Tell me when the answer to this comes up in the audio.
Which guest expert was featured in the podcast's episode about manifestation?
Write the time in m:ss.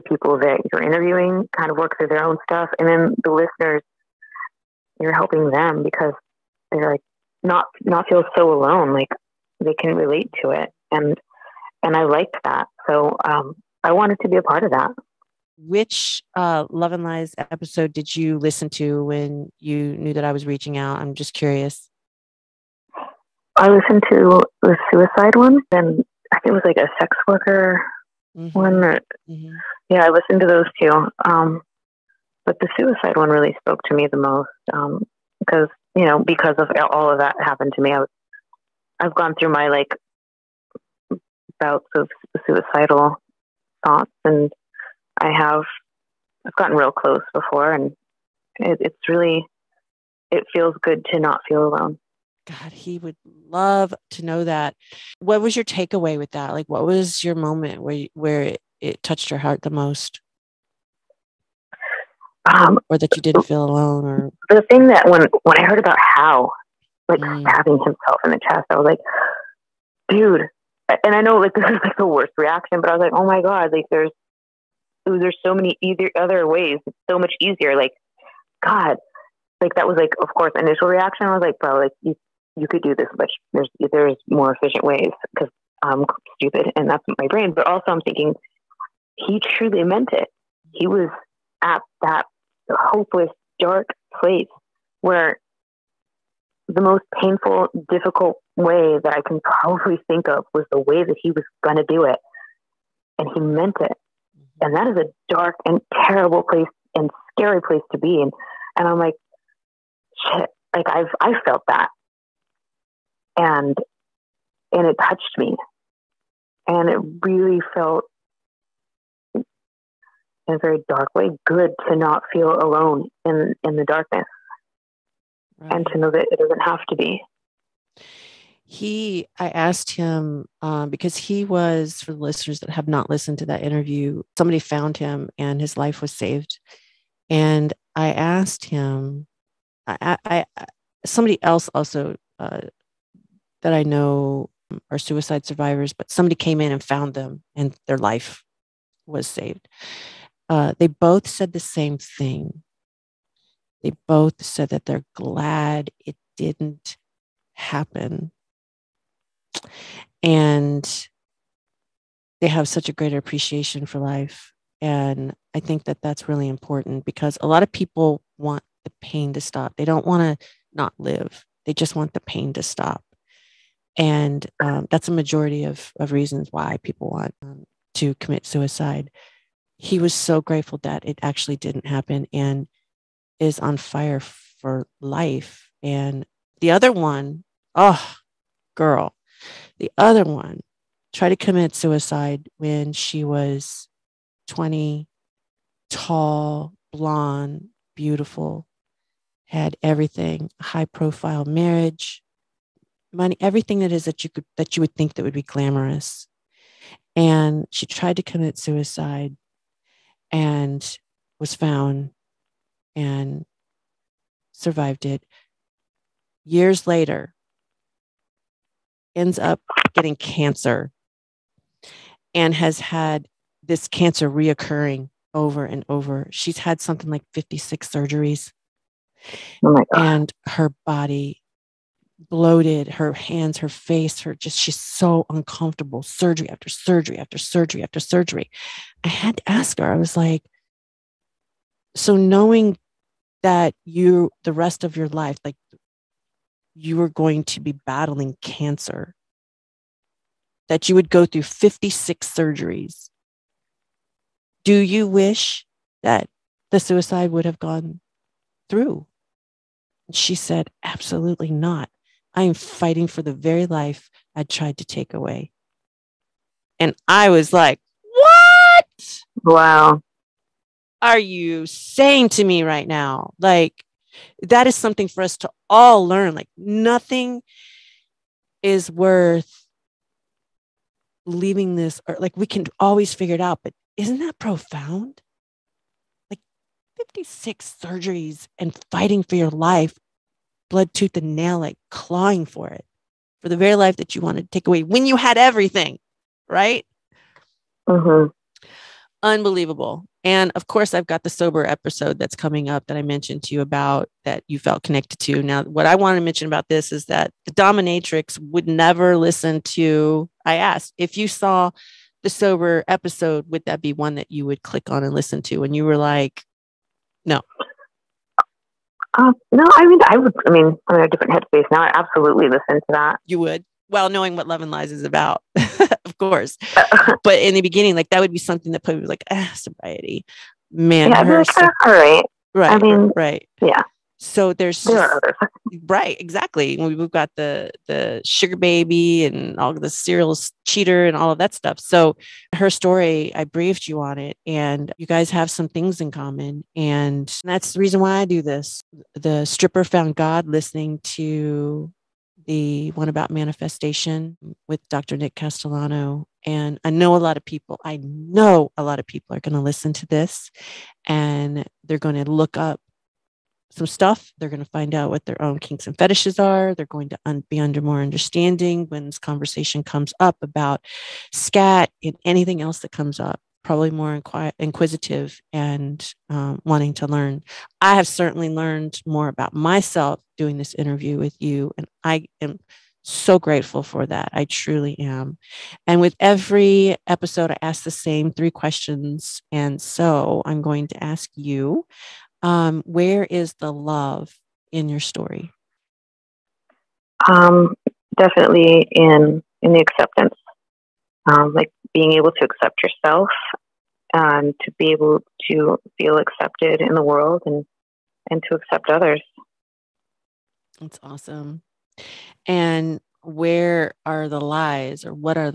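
5:54.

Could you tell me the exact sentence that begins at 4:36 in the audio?
Like, nothing is worth leaving this, or like, we can always figure it out, but isn't that profound?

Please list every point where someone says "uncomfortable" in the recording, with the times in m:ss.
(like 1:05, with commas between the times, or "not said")
3:55.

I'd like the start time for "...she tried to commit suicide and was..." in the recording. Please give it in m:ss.
3:27.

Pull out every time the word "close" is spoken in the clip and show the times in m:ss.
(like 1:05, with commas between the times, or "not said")
0:46.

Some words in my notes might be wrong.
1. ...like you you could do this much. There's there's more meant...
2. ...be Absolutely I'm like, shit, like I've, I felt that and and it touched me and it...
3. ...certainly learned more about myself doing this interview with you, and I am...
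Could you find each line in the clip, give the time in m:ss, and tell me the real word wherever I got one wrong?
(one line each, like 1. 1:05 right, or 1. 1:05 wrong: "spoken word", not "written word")
1. 1:21 wrong: "efficient", not "meant"
2. 1:47 wrong: "And", not "Absolutely"
3. 6:18 right.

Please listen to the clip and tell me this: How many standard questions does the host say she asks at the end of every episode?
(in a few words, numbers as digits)
3.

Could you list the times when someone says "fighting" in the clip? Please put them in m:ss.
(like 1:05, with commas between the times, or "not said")
4:22, 4:48.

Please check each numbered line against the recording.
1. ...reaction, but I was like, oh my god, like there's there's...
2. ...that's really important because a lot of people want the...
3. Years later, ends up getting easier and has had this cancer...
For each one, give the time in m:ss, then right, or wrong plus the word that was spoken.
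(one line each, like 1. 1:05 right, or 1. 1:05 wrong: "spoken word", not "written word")
1. 1:12 right
2. 2:46 right
3. 3:36 wrong: "cancer", not "easier".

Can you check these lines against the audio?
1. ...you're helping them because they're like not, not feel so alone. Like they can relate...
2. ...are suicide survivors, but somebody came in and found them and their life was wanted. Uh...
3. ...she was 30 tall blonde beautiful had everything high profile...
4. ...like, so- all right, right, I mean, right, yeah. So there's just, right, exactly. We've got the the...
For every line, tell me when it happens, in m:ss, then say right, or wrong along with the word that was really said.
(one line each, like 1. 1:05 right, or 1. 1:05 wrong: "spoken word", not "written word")
1. 0:04 right
2. 2:24 wrong: "saved", not "wanted"
3. 3:12 wrong: "20", not "30"
4. 5:31 right.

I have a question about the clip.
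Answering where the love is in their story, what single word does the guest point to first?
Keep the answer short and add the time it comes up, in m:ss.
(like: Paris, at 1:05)
Acceptance, at 6:39.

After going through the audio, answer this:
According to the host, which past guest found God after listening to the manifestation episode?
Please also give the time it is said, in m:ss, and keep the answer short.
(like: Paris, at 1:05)
The stripper, at 5:49.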